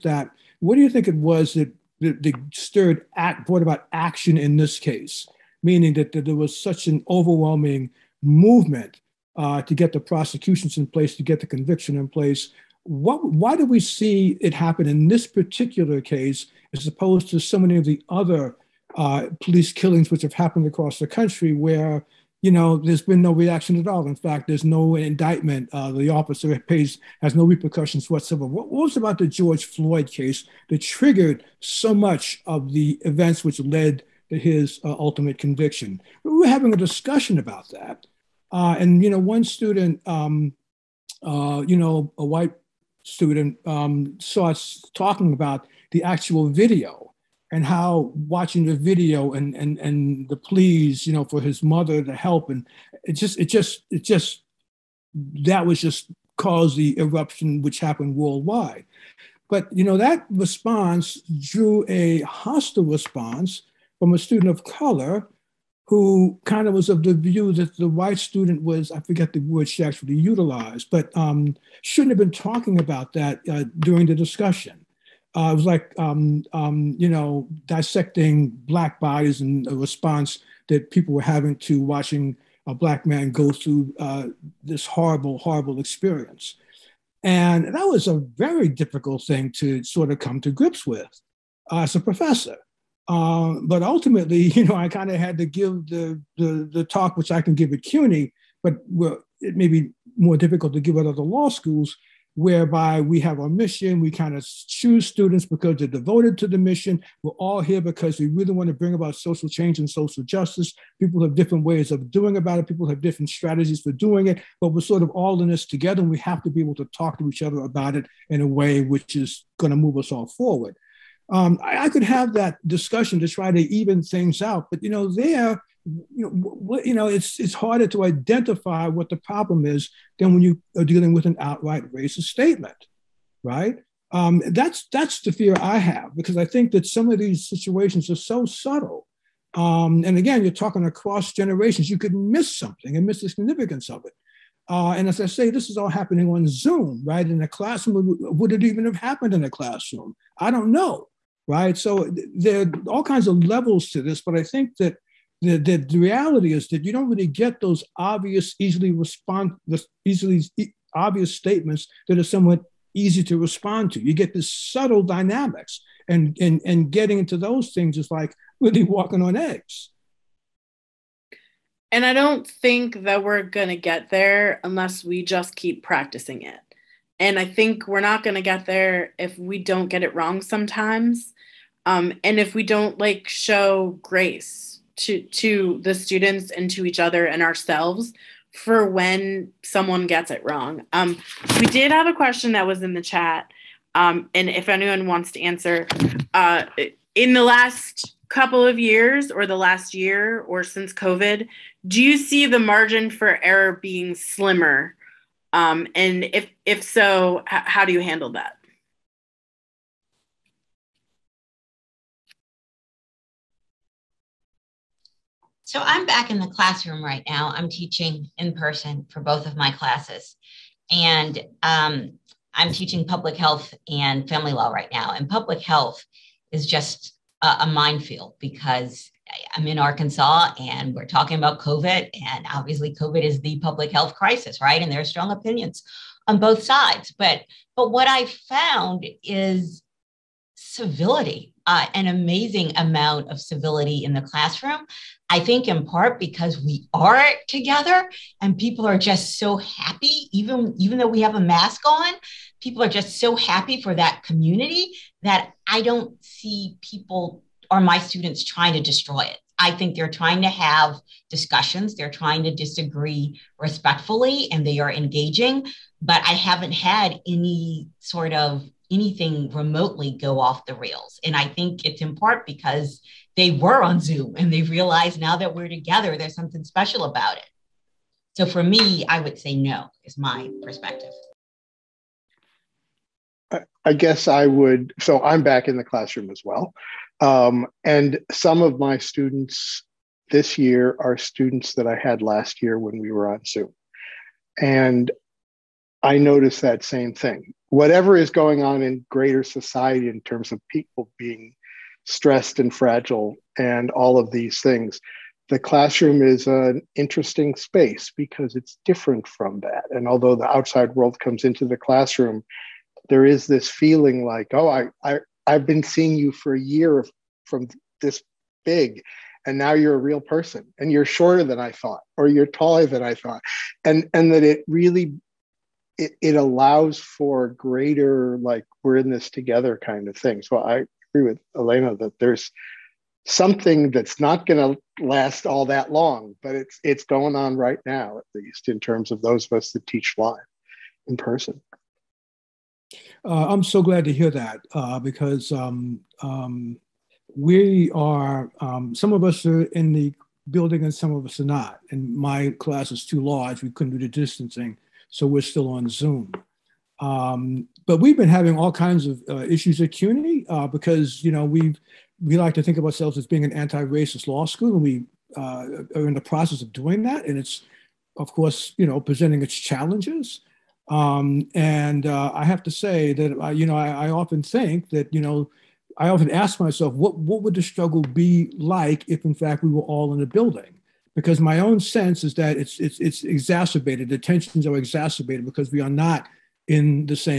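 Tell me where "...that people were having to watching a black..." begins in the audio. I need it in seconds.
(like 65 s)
80 s.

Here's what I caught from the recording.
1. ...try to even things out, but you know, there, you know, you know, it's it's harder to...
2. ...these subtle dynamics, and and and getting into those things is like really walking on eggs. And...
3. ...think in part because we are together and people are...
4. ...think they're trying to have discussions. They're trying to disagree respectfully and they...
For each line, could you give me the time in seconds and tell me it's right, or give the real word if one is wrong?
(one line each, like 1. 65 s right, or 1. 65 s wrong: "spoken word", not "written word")
1. 123 s right
2. 164 s right
3. 245 s right
4. 259 s right.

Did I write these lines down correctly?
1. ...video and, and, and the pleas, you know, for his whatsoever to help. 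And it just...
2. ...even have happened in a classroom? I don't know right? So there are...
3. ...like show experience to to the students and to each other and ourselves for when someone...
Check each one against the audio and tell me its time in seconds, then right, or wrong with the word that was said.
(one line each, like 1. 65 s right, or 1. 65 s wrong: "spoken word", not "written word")
1. 48 s wrong: "mother", not "whatsoever"
2. 148 s right
3. 182 s wrong: "grace", not "experience".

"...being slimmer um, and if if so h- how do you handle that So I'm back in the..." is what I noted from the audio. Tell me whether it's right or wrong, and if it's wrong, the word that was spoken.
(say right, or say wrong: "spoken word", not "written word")
right.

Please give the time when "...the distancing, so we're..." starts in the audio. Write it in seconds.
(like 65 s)
353 s.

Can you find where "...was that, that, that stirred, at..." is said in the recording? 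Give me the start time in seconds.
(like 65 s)
1 s.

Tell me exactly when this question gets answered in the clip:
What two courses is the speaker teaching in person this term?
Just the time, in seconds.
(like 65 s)
223 s.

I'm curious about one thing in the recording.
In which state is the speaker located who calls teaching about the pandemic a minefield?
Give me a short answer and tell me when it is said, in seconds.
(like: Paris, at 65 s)
Arkansas, at 229 s.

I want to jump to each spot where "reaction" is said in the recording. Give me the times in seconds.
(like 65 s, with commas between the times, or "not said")
23 s.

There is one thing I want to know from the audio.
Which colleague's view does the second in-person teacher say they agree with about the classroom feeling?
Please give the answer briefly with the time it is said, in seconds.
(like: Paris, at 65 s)
Alena, at 331 s.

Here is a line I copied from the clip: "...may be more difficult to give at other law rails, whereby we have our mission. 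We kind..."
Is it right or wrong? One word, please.
wrong.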